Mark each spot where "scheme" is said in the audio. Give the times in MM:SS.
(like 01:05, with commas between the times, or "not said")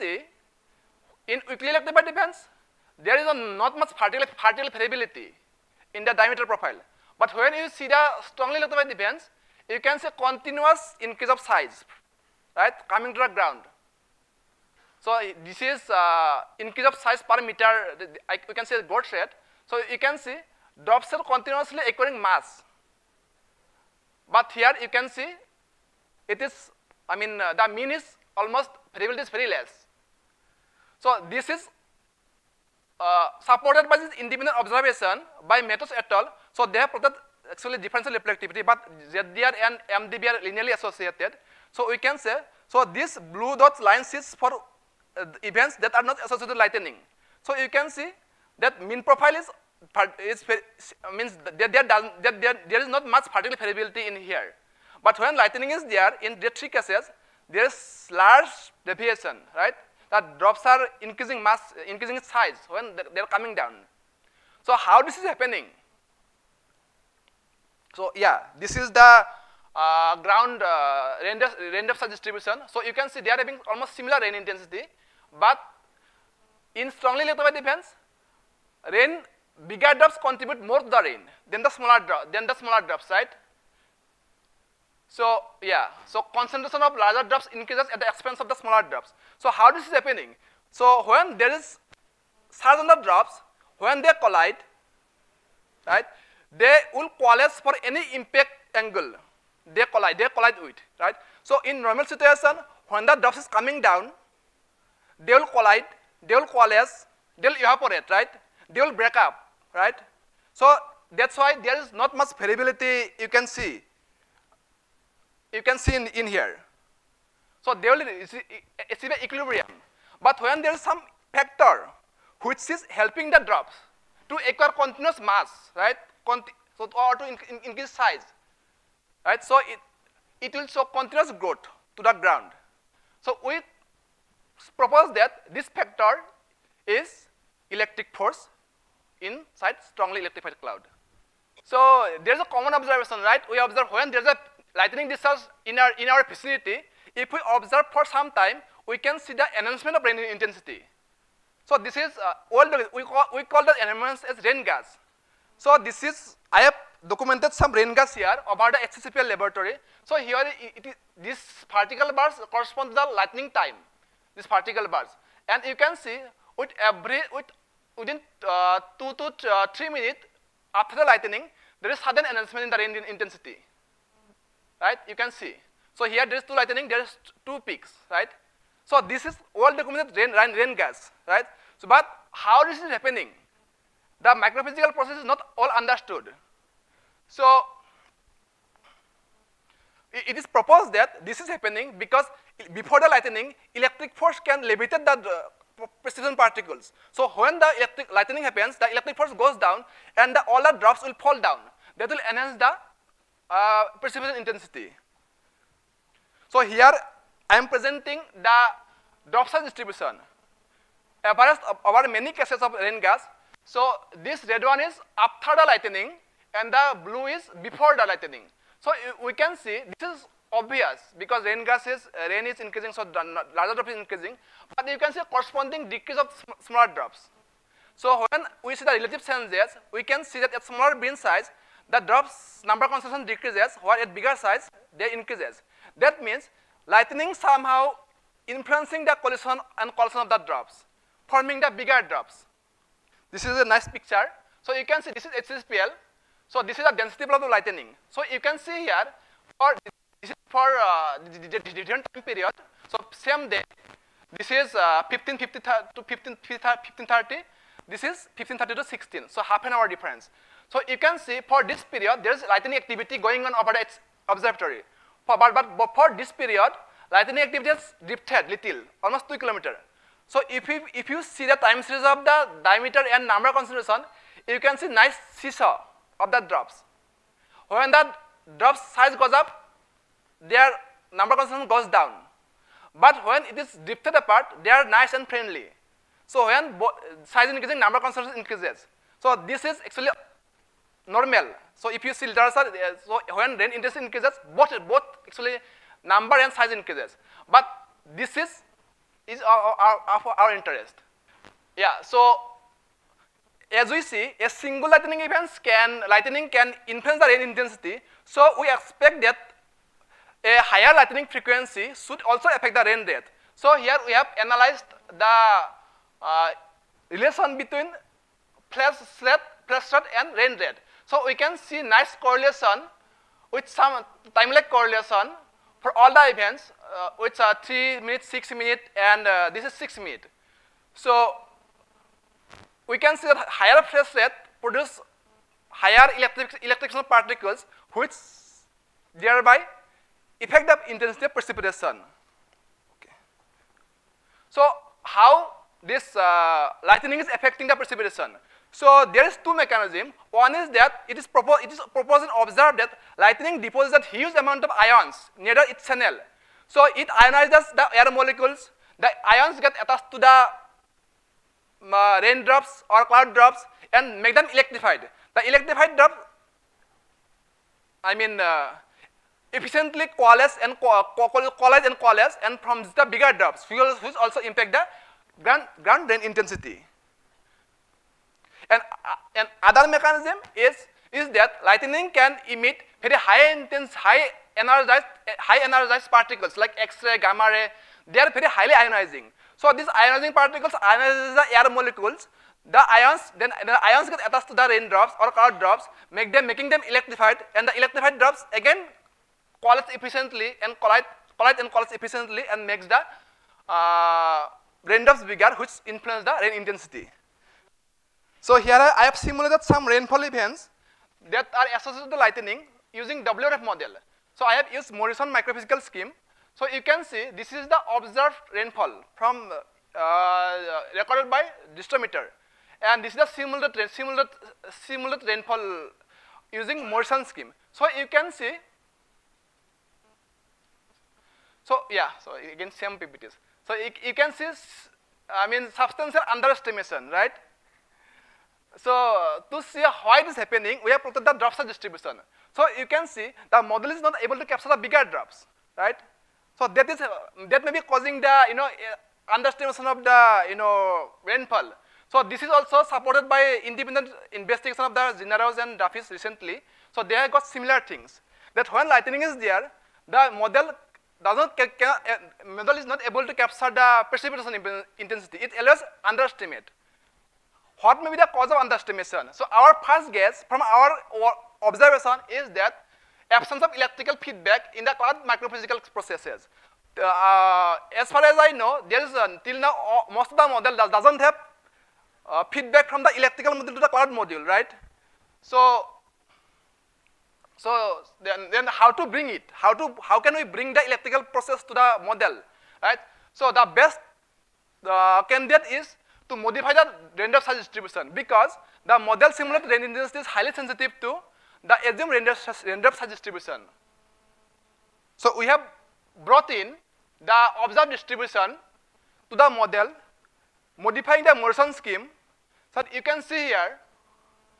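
06:55, 07:07, 08:31.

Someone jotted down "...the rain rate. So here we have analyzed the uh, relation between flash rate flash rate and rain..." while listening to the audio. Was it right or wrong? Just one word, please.
right.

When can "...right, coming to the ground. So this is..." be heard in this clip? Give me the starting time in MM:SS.
00:12.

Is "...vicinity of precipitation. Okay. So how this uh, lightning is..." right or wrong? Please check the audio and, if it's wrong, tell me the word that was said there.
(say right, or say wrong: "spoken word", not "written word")
wrong: "intensity", not "vicinity".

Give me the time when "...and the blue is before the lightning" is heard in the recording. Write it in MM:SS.
03:36.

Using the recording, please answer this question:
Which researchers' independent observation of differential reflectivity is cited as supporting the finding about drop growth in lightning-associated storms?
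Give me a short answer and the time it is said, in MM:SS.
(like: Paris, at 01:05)
Mattos et al., at 00:35.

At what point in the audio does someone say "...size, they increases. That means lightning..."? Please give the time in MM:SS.
03:54.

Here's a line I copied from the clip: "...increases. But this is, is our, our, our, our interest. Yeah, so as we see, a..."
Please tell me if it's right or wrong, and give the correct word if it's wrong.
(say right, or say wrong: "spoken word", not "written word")
right.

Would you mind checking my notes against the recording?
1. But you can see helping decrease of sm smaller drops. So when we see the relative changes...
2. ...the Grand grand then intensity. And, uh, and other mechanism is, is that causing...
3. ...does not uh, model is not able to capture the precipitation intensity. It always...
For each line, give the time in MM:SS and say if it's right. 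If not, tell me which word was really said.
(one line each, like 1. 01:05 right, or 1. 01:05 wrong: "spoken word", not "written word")
1. 03:44 wrong: "corresponding", not "helping"
2. 06:14 wrong: "lightning", not "causing"
3. 07:41 right.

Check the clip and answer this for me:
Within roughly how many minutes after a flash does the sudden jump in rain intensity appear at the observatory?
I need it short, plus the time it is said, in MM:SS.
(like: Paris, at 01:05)
2 to 3 minutes, at 02:48.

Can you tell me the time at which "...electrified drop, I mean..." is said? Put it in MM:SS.
06:05.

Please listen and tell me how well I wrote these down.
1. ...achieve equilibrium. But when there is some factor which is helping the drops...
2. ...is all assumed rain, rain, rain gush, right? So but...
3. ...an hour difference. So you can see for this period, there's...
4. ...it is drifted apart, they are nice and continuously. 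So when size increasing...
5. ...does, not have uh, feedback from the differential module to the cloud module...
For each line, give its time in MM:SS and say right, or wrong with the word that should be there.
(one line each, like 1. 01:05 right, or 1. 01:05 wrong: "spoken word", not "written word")
1. 01:58 right
2. 02:59 wrong: "documented", not "assumed"
3. 04:19 right
4. 04:43 wrong: "friendly", not "continuously"
5. 08:00 wrong: "electrical", not "differential".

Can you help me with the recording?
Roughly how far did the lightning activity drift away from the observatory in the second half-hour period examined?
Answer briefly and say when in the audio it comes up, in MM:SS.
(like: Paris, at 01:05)
2 kilometers, at 04:29.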